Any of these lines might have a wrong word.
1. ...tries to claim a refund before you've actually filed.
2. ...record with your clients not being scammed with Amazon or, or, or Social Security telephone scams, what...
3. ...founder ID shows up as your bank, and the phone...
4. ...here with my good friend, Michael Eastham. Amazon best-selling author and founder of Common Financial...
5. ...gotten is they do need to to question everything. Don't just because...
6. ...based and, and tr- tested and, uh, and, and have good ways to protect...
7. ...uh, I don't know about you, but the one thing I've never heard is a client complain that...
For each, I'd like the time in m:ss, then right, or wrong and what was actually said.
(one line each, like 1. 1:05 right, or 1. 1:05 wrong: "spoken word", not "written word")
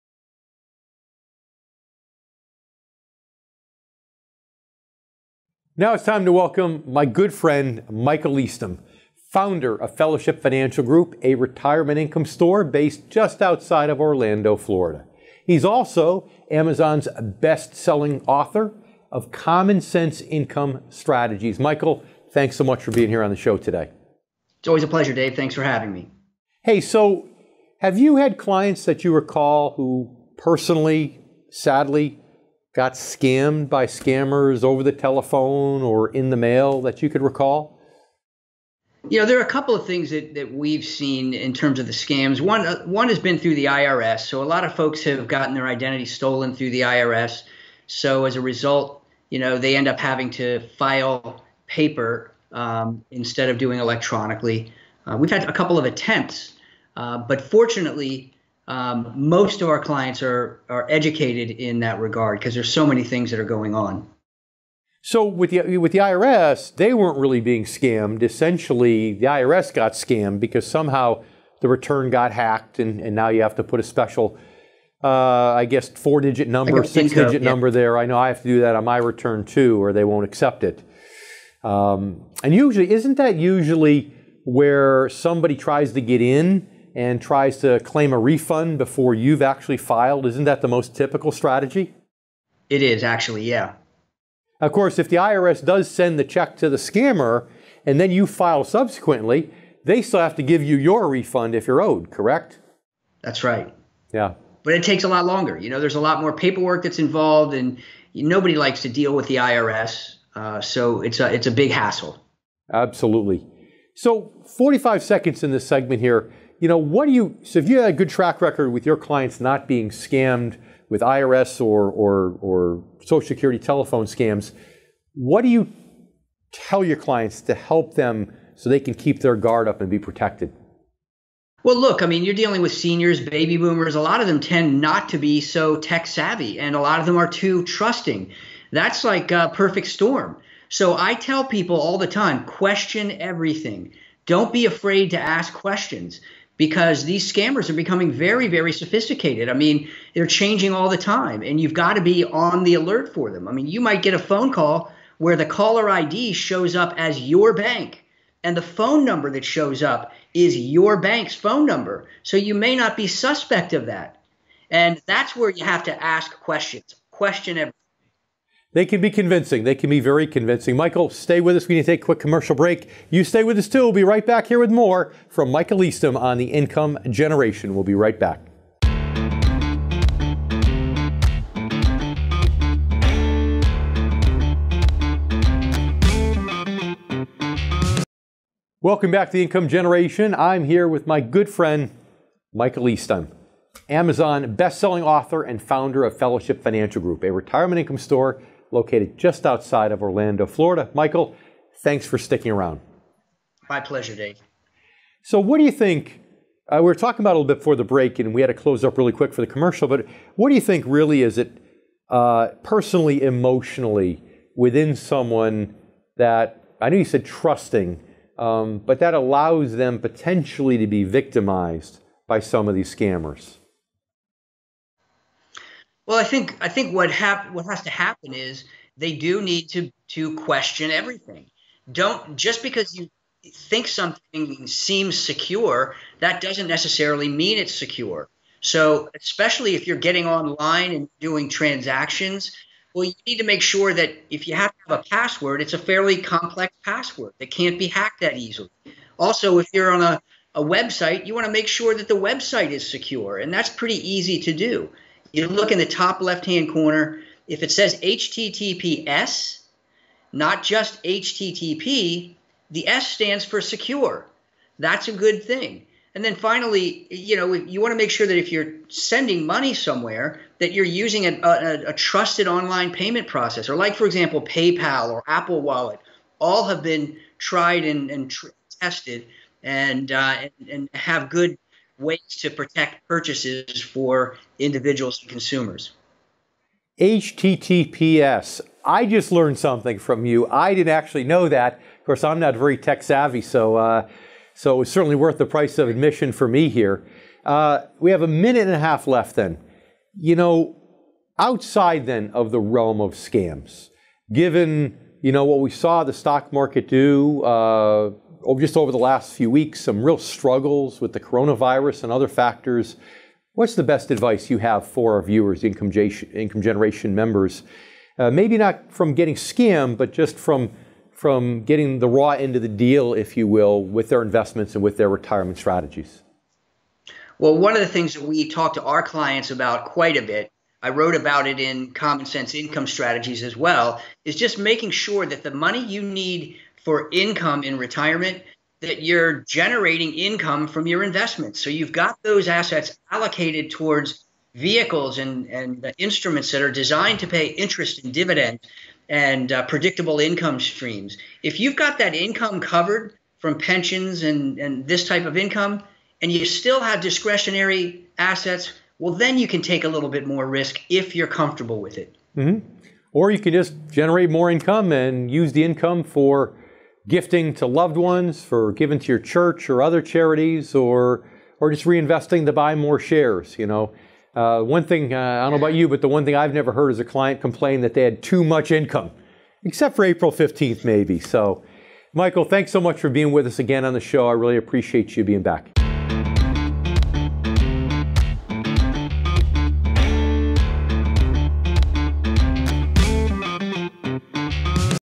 1. 1:27 right
2. 1:58 wrong: "IRS", not "Amazon"
3. 2:35 wrong: "caller", not "founder"
4. 3:10 wrong: "Fellowship", not "Common"
5. 3:47 wrong: "happen", not "gotten"
6. 4:37 wrong: "tried", not "based"
7. 6:15 right.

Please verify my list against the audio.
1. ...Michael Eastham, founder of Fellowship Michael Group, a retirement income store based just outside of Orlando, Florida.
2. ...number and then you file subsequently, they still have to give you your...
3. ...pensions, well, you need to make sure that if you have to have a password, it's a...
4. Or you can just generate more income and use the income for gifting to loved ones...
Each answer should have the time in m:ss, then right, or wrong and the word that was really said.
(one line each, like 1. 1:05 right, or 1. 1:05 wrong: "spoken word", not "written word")
1. 0:07 wrong: "Financial", not "Michael"
2. 1:36 wrong: "scammer", not "number"
3. 4:01 wrong: "transactions", not "pensions"
4. 6:03 right.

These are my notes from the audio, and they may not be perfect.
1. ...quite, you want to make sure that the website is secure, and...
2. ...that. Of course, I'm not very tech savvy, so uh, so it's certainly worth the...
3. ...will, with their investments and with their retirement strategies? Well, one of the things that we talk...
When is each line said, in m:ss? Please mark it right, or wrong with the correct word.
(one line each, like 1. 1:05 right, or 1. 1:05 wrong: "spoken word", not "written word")
1. 4:10 wrong: "website", not "quite"
2. 4:51 right
3. 5:23 right.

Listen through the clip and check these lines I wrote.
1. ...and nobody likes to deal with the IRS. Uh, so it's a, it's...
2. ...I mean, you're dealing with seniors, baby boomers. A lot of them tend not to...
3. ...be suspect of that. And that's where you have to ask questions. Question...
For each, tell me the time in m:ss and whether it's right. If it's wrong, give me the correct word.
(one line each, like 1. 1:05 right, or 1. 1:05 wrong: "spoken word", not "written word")
1. 1:47 right
2. 2:12 right
3. 2:42 right.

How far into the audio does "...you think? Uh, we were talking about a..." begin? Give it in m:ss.
3:25.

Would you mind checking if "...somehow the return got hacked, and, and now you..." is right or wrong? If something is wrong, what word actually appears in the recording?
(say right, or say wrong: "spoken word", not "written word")
right.